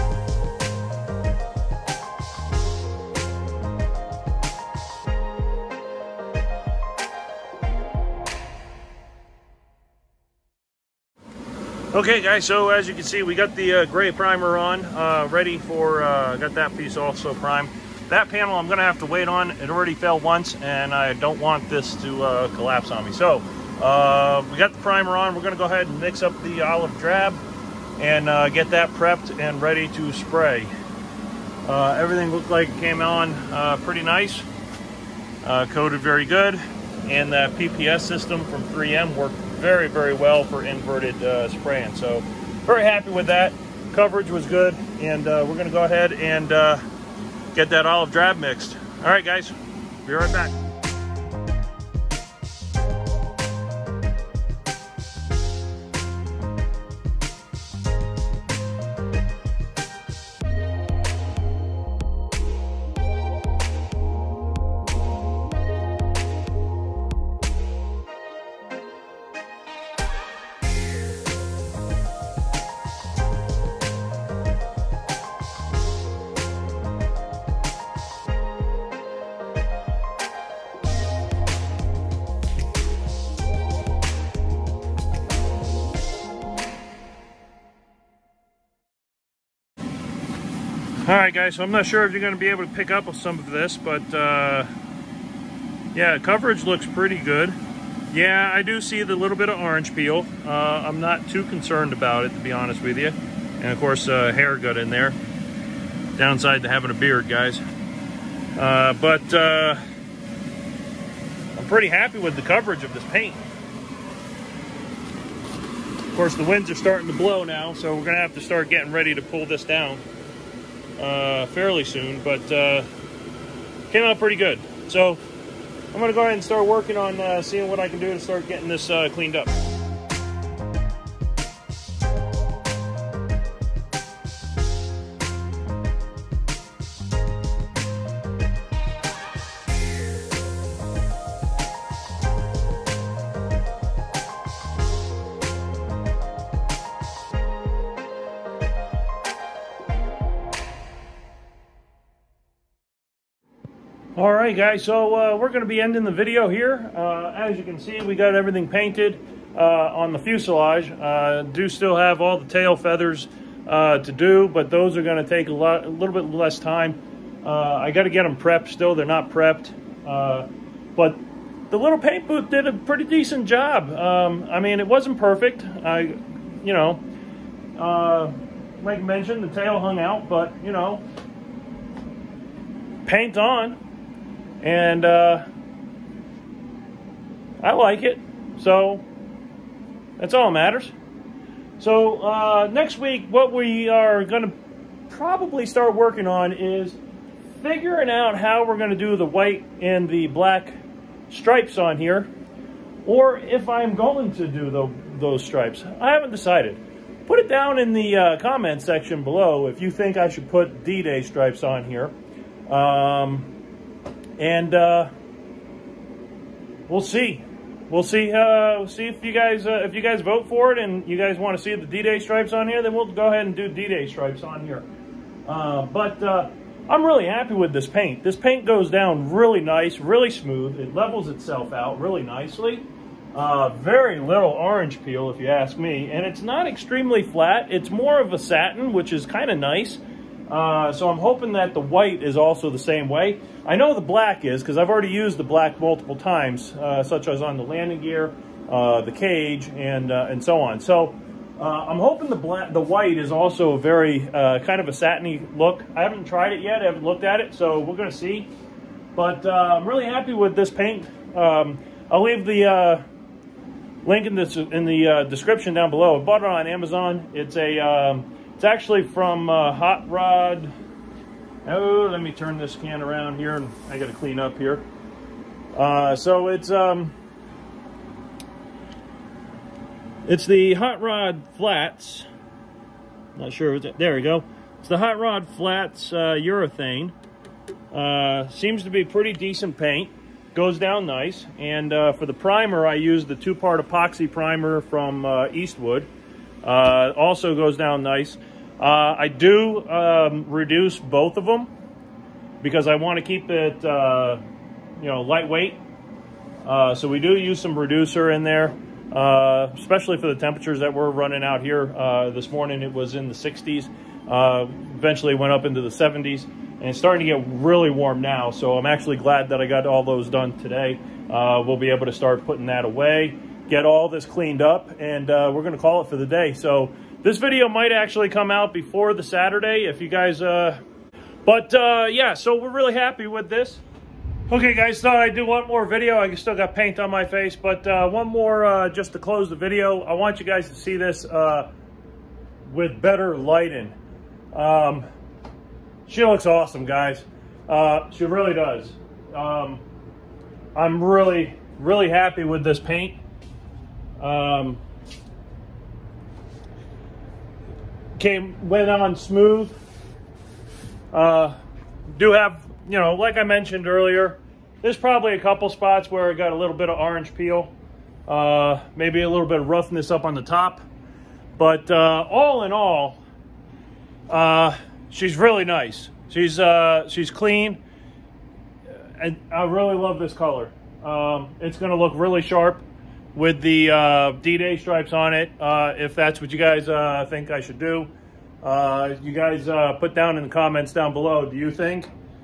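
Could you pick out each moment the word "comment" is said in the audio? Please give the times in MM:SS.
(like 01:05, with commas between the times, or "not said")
03:28, 06:30.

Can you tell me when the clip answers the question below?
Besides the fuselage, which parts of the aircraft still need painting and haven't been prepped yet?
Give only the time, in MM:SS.
02:42.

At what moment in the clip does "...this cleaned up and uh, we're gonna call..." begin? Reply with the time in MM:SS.
05:24.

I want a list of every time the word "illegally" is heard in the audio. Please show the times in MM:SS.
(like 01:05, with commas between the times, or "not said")
not said.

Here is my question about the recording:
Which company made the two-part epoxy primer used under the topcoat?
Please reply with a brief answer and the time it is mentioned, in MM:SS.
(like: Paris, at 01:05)
Eastwood, at 04:55.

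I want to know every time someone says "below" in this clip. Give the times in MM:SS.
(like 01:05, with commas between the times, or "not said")
03:29, 04:25, 06:31.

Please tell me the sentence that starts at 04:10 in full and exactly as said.
So uh, I'm hoping the black, the white is also a very uh, kind of a satiny look.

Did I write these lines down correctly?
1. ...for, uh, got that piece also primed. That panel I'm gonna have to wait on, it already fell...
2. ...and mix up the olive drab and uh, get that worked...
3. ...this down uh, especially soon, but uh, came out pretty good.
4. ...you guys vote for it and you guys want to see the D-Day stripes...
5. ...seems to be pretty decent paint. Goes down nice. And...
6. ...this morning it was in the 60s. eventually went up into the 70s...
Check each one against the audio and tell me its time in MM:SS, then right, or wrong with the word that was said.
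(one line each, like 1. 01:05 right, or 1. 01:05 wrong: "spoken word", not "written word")
1. 00:15 right
2. 00:25 wrong: "prepped", not "worked"
3. 01:59 wrong: "fairly", not "especially"
4. 03:39 right
5. 04:48 right
6. 05:12 right.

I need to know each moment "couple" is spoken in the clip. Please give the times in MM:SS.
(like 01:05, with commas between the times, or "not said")
06:05.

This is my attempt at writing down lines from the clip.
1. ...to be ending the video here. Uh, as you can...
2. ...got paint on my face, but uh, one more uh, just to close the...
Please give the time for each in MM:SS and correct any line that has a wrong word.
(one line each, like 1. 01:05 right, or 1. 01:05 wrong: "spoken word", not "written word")
1. 02:35 right
2. 05:36 right.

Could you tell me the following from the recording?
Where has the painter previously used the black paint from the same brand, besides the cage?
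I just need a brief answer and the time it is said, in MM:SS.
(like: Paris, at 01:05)
Landing gear, at 04:07.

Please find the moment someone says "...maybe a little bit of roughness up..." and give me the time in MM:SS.
06:08.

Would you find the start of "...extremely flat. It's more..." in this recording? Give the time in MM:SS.
03:56.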